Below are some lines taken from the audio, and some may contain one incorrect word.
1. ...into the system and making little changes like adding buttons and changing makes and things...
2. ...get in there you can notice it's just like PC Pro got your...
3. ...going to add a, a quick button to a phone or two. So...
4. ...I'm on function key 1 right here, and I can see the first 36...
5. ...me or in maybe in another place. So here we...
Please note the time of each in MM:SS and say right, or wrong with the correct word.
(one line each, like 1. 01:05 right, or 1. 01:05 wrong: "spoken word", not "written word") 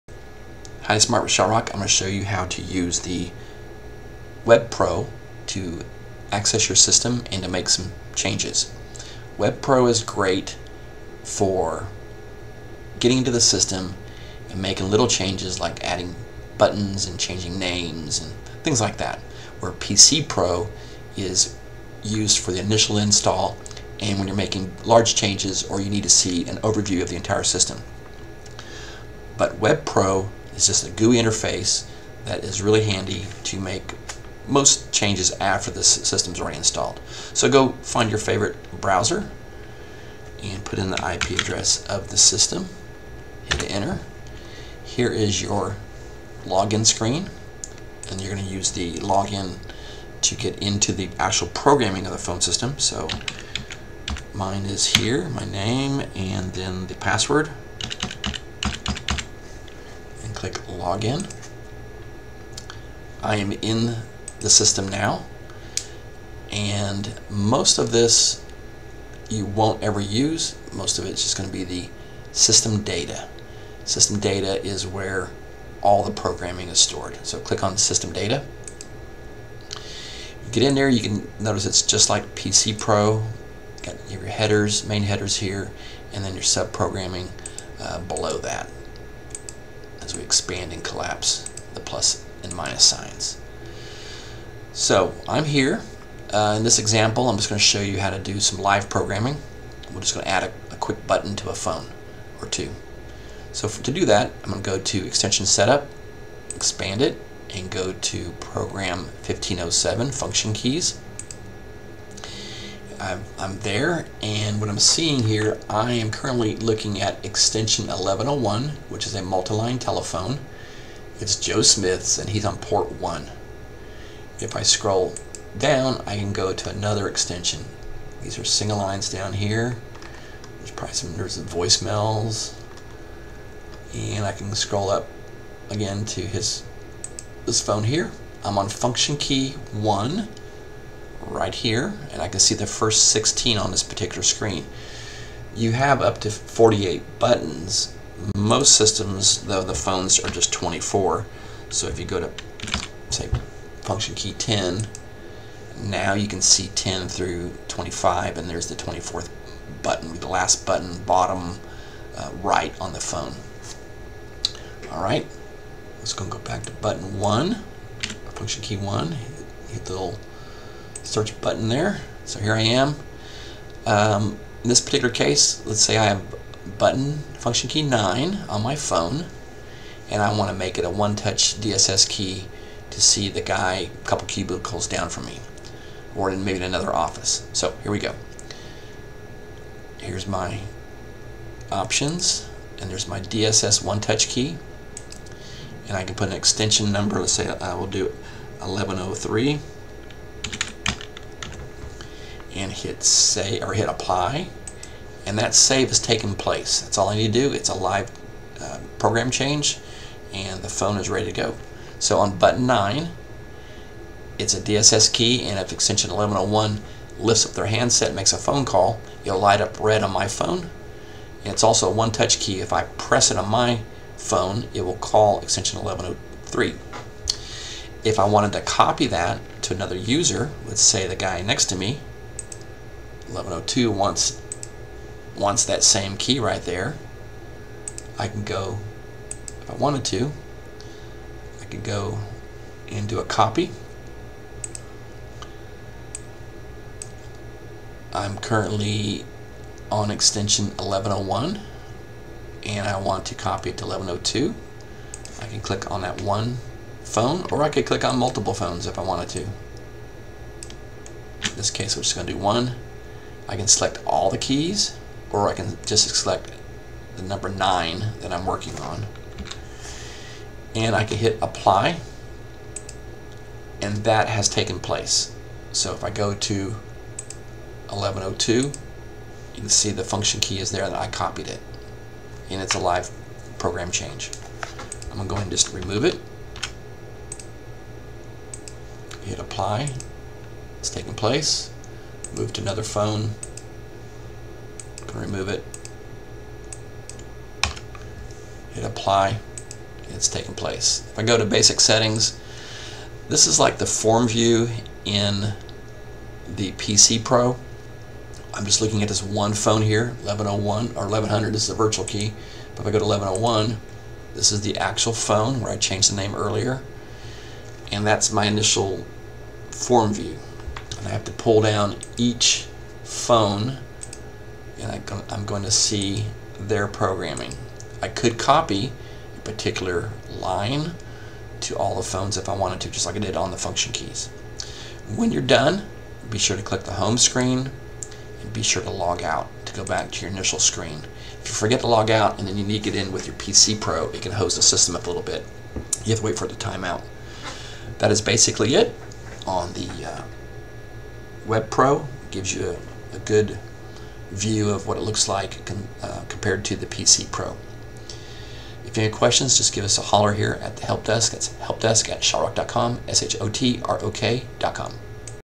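1. 00:13 wrong: "names", not "makes"
2. 01:20 right
3. 01:40 right
4. 02:18 wrong: "16", not "36"
5. 03:05 wrong: "office", not "place".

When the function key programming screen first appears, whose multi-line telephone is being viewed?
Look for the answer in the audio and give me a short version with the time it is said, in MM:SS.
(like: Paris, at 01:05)
Joe Smith, at 02:01.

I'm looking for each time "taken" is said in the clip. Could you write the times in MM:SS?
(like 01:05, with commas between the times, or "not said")
03:25, 04:34, 05:00.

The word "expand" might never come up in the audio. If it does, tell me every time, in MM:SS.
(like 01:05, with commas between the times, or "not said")
01:30, 01:46.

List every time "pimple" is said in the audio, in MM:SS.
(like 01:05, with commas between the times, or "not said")
not said.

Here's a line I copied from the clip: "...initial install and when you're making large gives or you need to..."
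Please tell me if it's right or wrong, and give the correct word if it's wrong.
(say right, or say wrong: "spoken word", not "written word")
wrong: "changes", not "gives".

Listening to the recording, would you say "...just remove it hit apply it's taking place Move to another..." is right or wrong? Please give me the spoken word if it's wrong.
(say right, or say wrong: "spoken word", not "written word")
right.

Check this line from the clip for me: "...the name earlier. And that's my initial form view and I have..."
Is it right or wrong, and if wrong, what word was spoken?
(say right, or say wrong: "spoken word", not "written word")
right.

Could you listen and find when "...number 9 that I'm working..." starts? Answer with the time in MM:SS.
04:27.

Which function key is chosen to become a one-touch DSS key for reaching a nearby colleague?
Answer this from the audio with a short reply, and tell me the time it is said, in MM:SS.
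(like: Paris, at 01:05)
9, at 02:57.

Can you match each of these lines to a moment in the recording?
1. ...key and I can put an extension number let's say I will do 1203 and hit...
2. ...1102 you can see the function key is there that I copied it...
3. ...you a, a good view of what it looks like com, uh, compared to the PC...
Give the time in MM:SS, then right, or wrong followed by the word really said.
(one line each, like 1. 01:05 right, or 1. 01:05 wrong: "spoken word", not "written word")
1. 03:14 wrong: "1103", not "1203"
2. 04:37 right
3. 05:52 right.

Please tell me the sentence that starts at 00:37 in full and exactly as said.
So go find your favorite browser and put in the IP address of the system.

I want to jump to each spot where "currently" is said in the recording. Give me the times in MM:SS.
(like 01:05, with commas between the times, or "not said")
01:56, 04:08.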